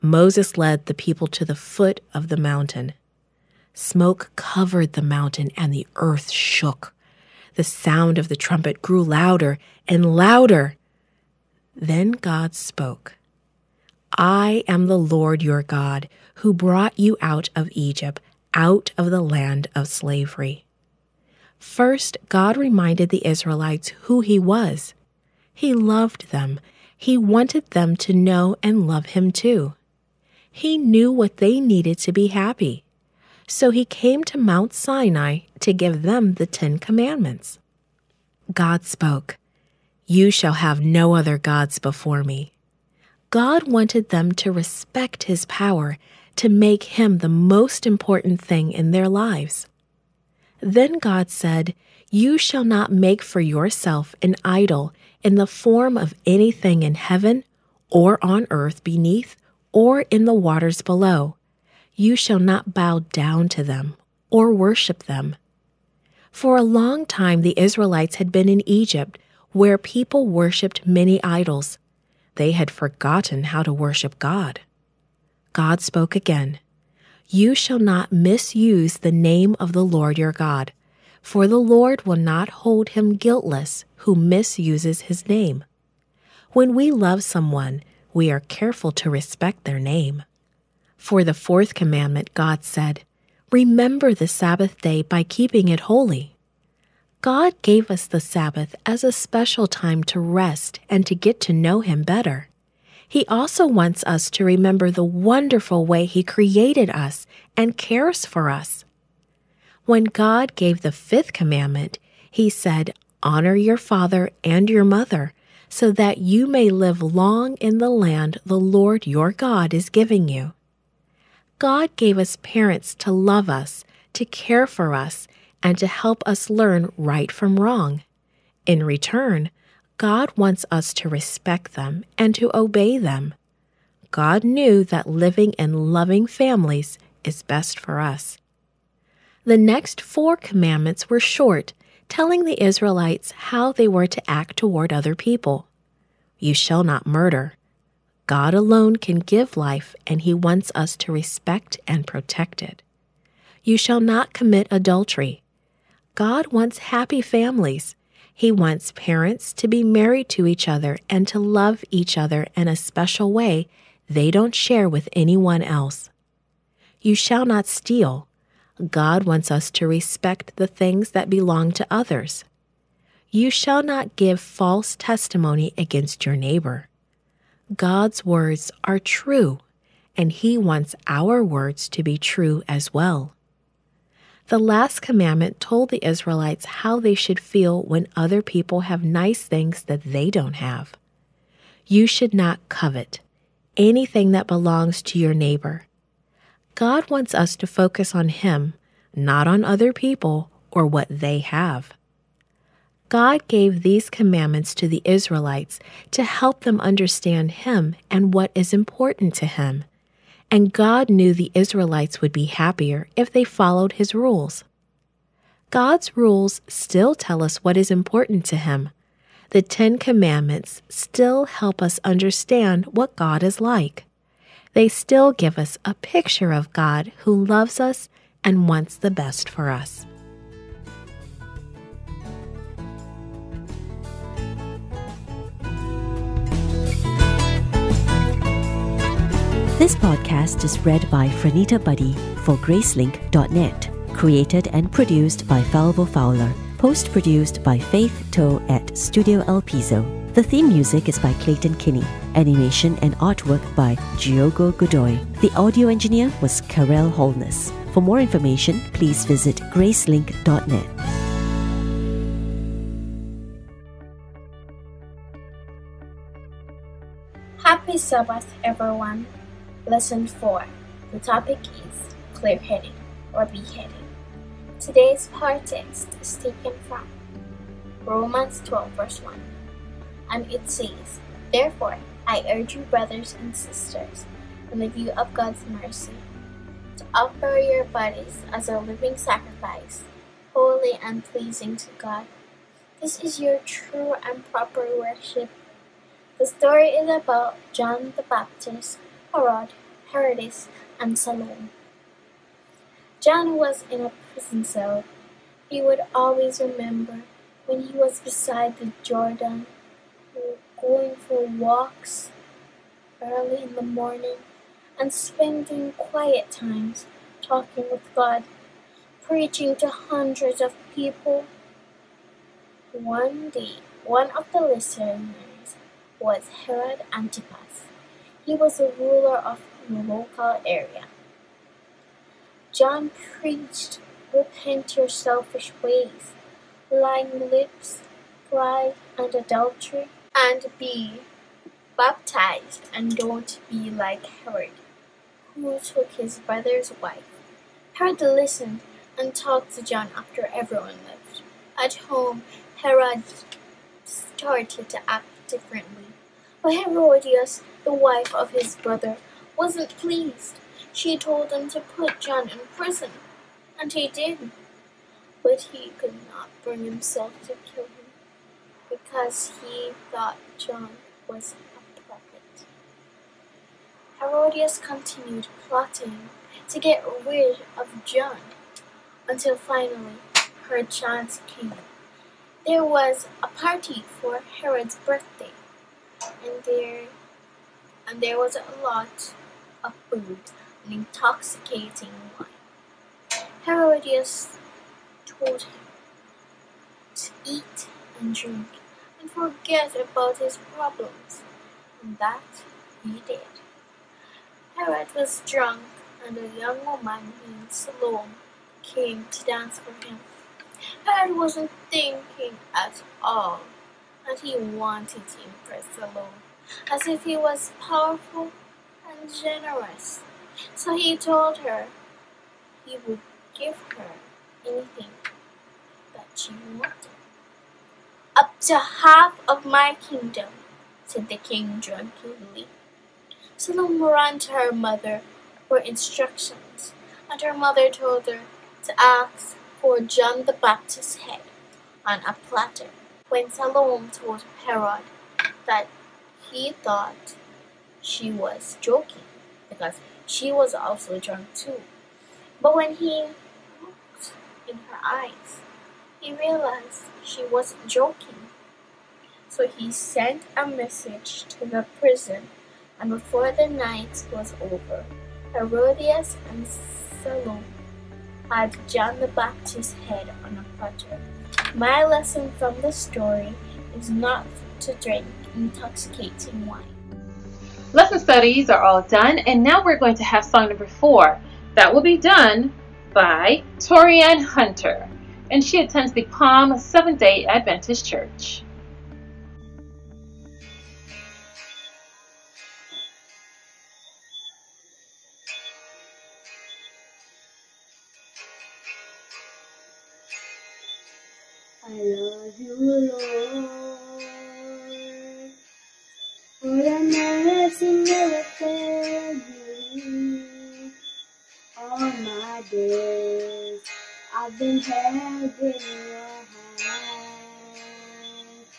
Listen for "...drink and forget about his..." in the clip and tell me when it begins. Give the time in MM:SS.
06:38.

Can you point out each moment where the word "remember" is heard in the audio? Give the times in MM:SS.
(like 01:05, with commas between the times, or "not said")
01:33, 01:44, 05:06.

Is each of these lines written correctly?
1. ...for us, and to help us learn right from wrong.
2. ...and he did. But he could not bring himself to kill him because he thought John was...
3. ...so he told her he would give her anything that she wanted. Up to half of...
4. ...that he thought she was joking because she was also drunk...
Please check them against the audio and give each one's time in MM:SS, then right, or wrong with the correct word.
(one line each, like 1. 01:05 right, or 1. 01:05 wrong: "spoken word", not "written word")
1. 02:04 right
2. 06:03 right
3. 07:00 right
4. 07:25 right.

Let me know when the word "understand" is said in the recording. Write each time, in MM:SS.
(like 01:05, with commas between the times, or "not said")
03:26, 03:42.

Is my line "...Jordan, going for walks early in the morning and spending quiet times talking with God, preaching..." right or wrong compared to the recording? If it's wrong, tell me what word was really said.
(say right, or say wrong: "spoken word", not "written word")
right.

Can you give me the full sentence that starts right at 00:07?
The sound of the trumpet grew louder and louder.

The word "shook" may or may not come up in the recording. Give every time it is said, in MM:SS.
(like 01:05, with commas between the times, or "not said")
00:06.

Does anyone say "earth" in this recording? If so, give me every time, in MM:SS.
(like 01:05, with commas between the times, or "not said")
00:05, 00:58.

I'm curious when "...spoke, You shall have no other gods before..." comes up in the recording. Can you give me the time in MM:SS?
00:38.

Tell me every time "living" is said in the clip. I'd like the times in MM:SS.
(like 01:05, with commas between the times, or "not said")
02:15, 04:48.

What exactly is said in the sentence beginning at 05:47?
Herod listened and talked to John after everyone left.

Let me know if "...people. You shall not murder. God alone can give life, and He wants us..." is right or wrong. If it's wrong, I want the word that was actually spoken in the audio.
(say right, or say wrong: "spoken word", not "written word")
right.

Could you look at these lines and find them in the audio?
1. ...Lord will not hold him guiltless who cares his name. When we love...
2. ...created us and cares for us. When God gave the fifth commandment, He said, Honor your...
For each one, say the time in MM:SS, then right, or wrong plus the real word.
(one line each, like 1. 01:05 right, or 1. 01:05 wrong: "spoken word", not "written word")
1. 01:21 wrong: "misuses", not "cares"
2. 01:46 right.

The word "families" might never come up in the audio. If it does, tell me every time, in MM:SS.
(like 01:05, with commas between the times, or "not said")
02:16, 02:37.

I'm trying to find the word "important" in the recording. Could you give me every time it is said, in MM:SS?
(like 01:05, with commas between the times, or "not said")
00:47, 03:28, 03:37.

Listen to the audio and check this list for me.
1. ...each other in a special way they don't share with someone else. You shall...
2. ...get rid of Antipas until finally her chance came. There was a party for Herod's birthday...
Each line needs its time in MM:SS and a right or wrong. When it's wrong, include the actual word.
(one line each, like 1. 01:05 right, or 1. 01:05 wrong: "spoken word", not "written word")
1. 02:41 wrong: "anyone", not "someone"
2. 06:16 wrong: "John", not "Antipas".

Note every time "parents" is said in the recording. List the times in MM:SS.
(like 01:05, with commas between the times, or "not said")
02:02, 02:38.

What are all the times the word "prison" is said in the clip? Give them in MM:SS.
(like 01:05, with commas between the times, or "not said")
05:04, 06:02, 07:41.